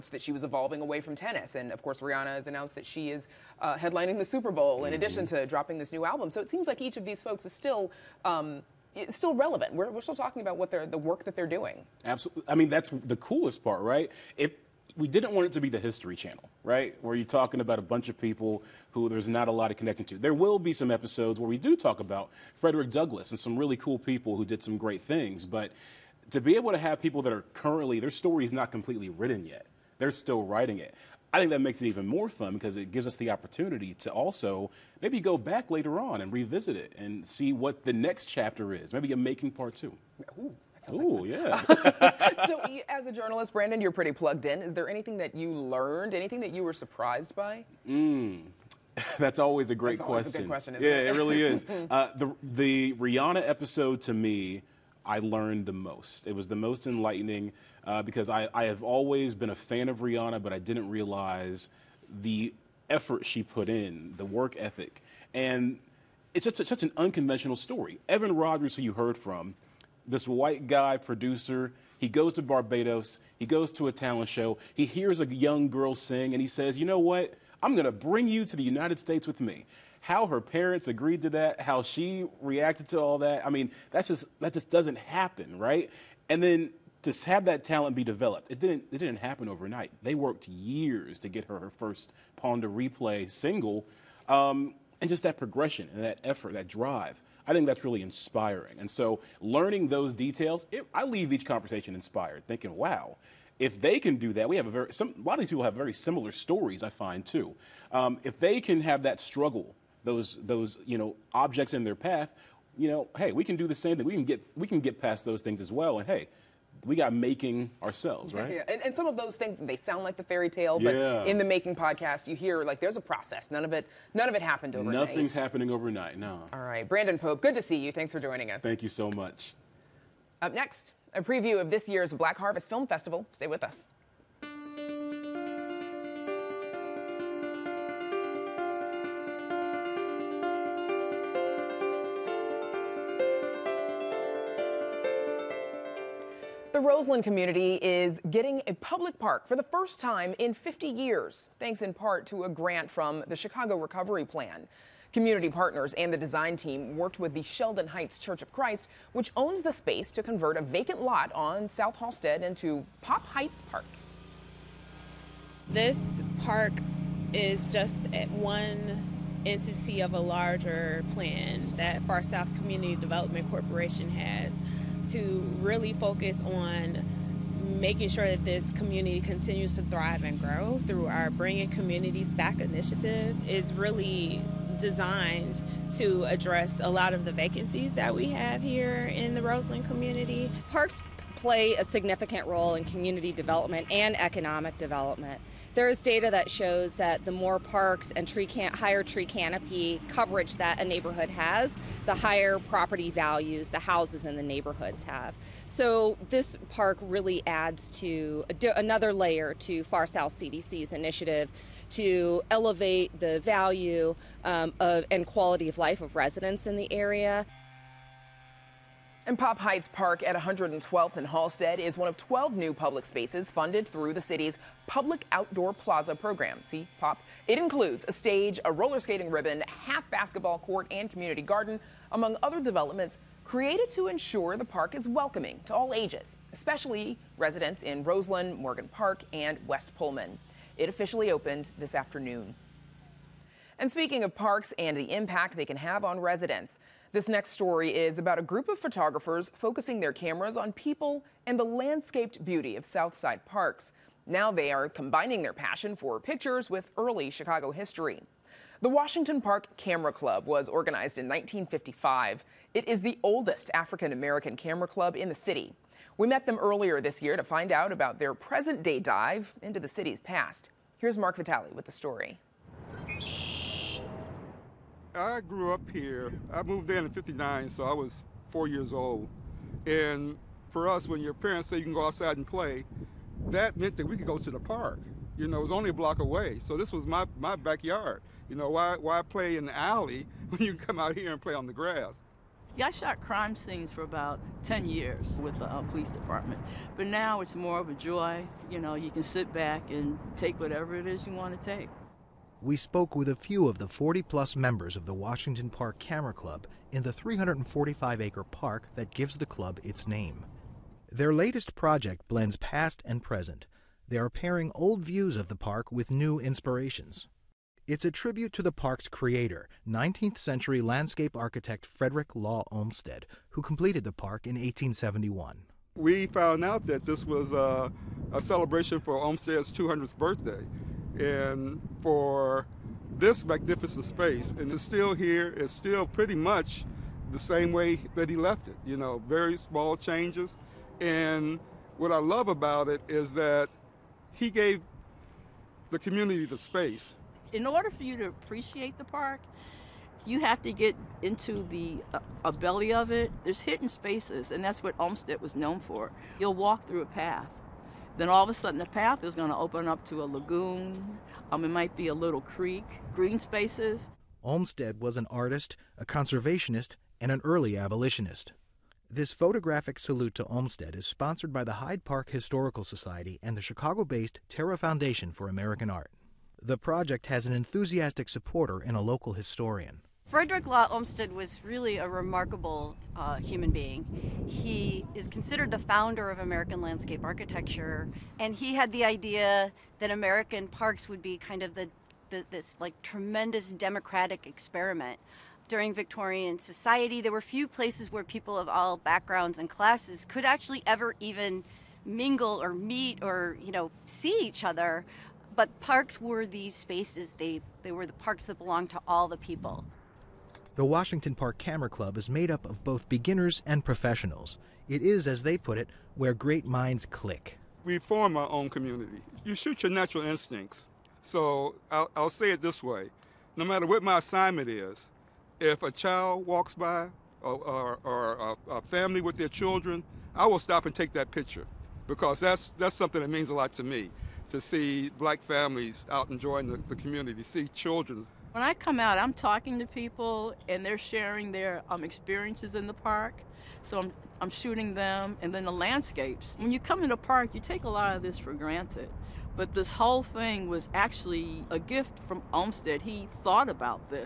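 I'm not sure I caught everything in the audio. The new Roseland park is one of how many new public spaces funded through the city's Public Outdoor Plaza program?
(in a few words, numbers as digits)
12.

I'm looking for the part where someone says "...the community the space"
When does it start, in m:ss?
5:45.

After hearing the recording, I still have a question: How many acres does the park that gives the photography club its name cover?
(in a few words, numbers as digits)
345.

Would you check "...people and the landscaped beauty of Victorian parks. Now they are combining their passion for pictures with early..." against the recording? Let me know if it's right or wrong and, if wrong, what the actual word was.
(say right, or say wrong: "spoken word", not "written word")
wrong: "Southside", not "Victorian".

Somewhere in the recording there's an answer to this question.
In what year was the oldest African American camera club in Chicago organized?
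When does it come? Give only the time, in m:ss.
4:21.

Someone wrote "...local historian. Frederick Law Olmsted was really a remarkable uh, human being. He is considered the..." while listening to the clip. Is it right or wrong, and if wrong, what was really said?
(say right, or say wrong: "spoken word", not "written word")
right.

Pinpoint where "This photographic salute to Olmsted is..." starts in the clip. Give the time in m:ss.
6:09.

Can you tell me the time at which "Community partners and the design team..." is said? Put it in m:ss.
2:35.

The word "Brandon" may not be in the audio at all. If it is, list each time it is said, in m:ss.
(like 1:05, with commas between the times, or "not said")
0:43, 2:06.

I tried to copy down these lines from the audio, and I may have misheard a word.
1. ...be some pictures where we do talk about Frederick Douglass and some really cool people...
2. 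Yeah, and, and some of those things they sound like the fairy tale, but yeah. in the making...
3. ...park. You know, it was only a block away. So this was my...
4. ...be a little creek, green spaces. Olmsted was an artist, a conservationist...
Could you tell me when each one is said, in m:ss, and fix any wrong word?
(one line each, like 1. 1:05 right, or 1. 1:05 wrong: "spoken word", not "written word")
1. 0:20 wrong: "episodes", not "pictures"
2. 1:58 right
3. 4:44 right
4. 6:01 right.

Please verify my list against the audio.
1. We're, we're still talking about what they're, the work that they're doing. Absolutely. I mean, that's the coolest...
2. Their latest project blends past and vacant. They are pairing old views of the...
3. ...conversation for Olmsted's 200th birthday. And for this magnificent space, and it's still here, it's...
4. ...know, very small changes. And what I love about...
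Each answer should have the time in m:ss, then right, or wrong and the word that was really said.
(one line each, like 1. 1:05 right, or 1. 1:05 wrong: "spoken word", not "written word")
1. 0:09 right
2. 5:11 wrong: "present", not "vacant"
3. 5:28 wrong: "celebration", not "conversation"
4. 5:38 right.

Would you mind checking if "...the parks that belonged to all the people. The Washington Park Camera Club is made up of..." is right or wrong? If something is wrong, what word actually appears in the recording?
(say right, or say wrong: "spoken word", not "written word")
right.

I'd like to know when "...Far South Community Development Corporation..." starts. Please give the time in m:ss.
2:52.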